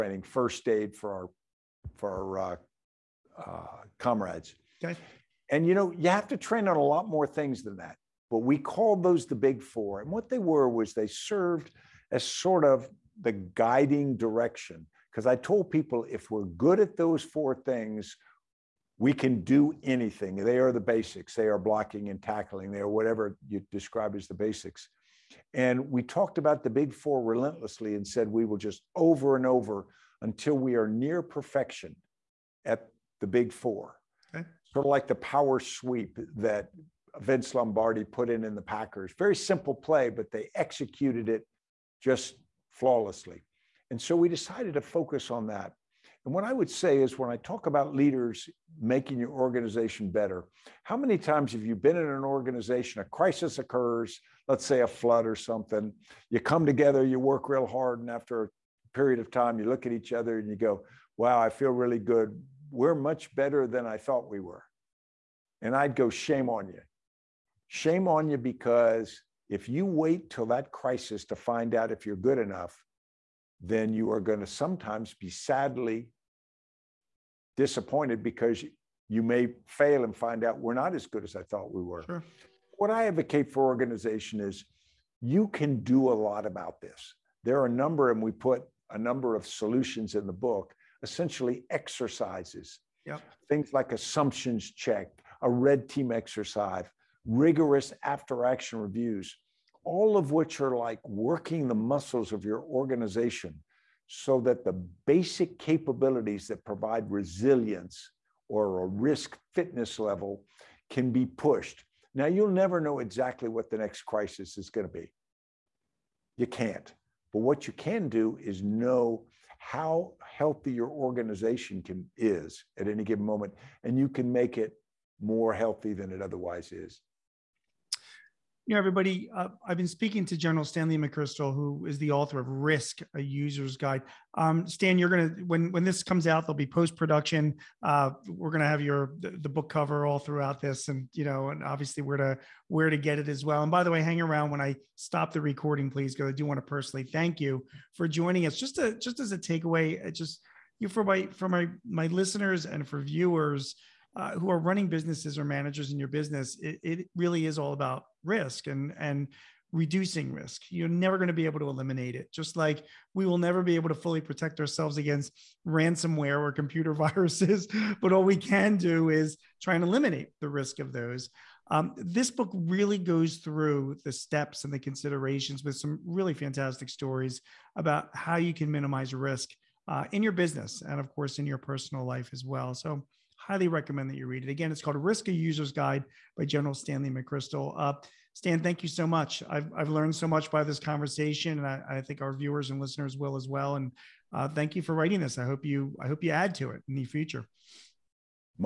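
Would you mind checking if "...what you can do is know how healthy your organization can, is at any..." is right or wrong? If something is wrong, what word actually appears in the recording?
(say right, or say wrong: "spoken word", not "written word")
right.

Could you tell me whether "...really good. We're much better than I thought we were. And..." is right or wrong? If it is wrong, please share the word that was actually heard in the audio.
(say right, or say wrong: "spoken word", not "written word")
right.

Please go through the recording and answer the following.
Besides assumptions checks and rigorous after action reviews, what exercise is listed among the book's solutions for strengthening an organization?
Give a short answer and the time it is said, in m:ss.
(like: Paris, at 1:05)
red team exercise, at 1:35.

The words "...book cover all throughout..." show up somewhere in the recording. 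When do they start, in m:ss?
2:19.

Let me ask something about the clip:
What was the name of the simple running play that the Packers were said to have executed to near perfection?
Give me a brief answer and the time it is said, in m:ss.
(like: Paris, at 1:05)
power sweep, at 0:35.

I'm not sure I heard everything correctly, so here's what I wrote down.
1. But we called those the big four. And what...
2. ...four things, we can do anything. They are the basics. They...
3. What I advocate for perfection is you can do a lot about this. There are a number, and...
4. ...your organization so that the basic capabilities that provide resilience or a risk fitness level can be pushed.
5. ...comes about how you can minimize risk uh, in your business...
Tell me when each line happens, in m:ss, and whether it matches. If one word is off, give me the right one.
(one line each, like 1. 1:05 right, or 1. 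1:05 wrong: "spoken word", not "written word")
1. 0:08 right
2. 0:17 right
3. 1:22 wrong: "organization", not "perfection"
4. 1:42 right
5. 2:56 wrong: "stories", not "comes".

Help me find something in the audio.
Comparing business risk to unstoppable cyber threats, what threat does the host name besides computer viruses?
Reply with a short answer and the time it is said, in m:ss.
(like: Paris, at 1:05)
ransomware, at 2:45.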